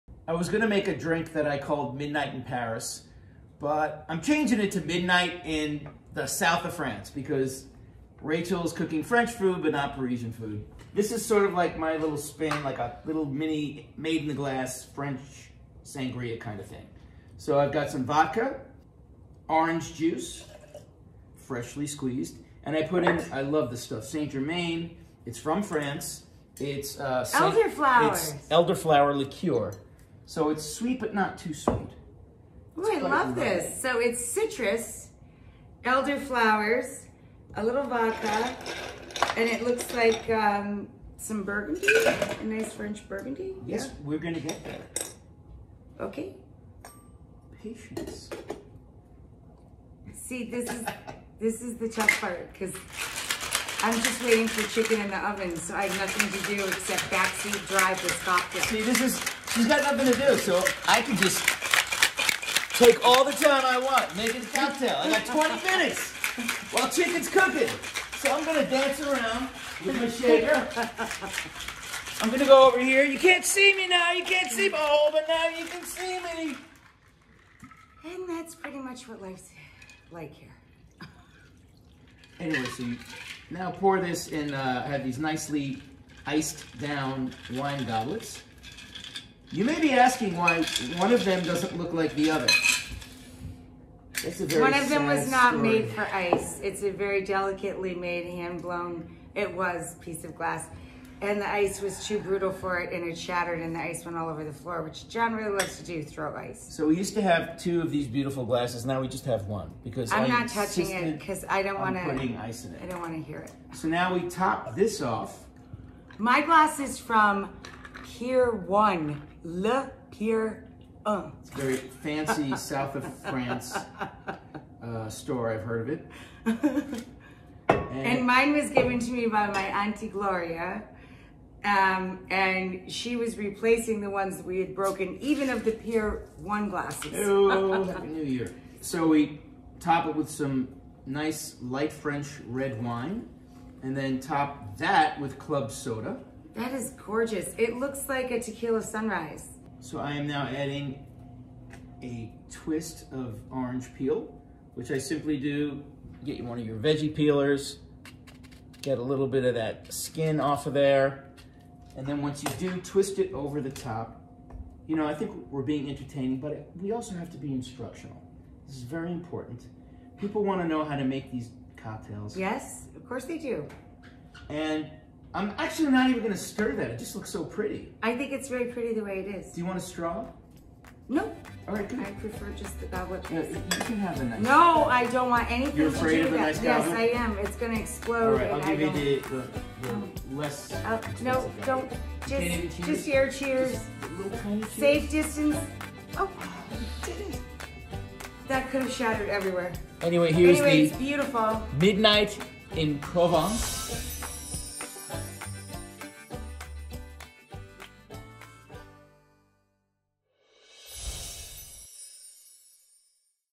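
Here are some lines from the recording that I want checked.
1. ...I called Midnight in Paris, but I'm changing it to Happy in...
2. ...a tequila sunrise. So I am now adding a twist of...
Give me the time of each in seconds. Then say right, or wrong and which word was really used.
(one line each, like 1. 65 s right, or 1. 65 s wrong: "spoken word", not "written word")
1. 1 s wrong: "Midnight", not "Happy"
2. 148 s right.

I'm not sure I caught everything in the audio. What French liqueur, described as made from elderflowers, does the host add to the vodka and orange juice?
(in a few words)
Saint Germain.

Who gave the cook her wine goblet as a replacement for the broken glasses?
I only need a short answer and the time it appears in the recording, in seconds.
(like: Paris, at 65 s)
Auntie Gloria, at 129 s.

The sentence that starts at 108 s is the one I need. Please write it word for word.
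Now we just have one because I'm I not touching it because I don't want to.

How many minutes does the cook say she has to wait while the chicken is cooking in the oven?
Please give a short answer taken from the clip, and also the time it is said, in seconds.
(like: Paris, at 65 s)
20, at 65 s.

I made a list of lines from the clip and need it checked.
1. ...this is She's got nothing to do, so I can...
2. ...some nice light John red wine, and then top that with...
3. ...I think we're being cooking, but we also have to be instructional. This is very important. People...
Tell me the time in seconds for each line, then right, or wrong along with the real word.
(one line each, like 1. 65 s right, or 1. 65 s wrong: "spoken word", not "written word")
1. 58 s right
2. 140 s wrong: "French", not "John"
3. 165 s wrong: "entertaining", not "cooking".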